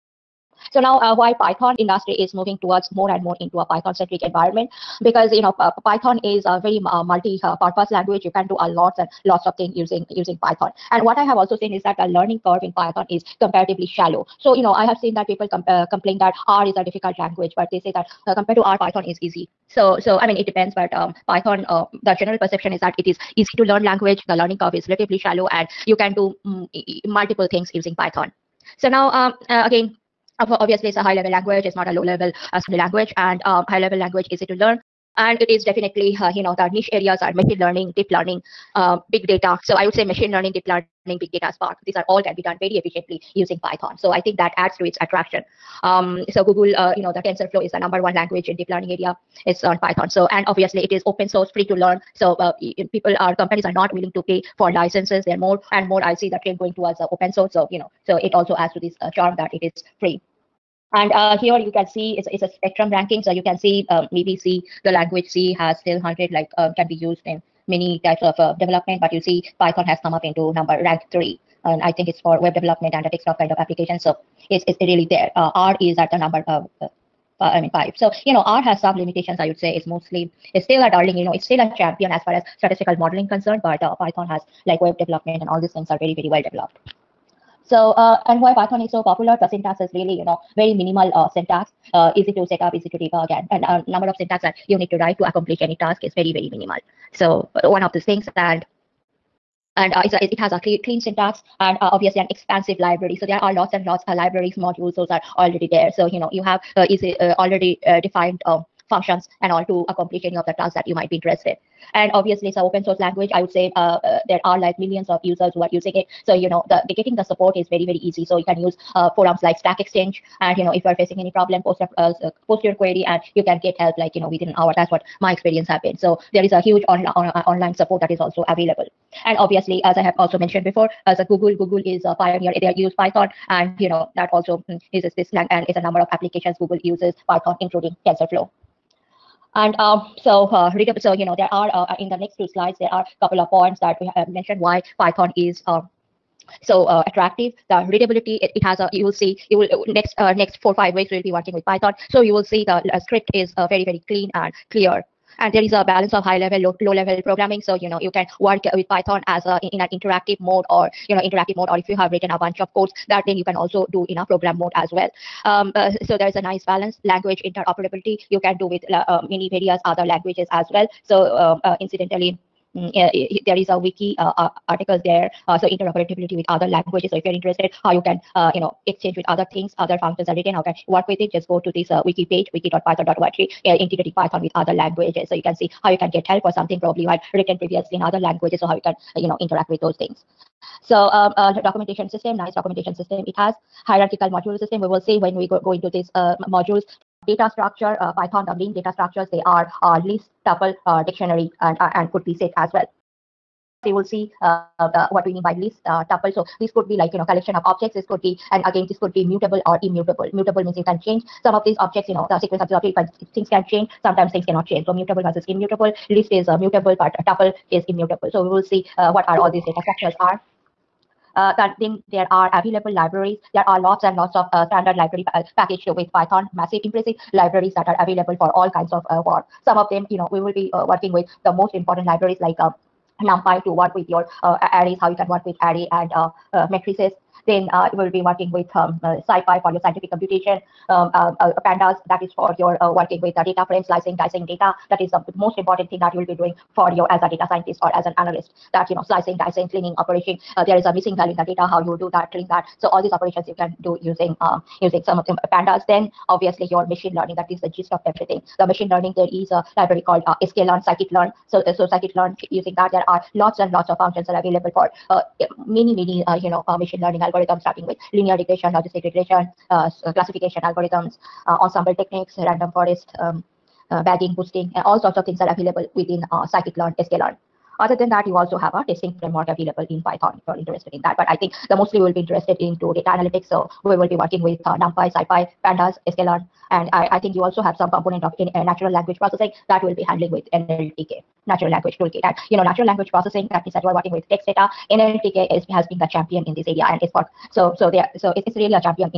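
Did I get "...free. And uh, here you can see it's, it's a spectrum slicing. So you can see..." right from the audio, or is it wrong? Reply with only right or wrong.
wrong.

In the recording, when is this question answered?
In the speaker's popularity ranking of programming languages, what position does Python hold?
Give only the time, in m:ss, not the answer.
1:10.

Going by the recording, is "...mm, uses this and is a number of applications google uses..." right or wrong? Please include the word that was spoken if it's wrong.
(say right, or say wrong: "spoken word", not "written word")
right.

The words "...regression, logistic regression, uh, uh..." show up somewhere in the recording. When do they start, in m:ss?
4:28.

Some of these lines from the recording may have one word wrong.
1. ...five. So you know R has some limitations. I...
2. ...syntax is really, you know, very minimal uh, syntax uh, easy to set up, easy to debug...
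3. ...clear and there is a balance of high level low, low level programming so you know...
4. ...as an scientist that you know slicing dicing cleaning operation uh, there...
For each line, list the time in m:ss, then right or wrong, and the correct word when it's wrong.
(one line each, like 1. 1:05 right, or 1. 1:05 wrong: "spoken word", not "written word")
1. 1:17 right
2. 1:29 right
3. 2:34 right
4. 4:07 wrong: "analyst", not "scientist".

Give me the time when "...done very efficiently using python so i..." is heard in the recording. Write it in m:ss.
0:42.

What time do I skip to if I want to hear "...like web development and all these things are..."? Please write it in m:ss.
1:24.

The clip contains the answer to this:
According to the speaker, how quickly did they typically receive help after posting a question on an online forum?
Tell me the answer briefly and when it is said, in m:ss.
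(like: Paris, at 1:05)
within an hour, at 2:04.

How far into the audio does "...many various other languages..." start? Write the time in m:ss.
2:49.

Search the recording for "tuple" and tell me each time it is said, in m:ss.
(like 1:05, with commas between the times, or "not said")
3:20, 3:26, 3:37.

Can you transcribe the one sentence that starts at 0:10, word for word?
And what I have also seen is that the learning curve in Python is comparatively shallow.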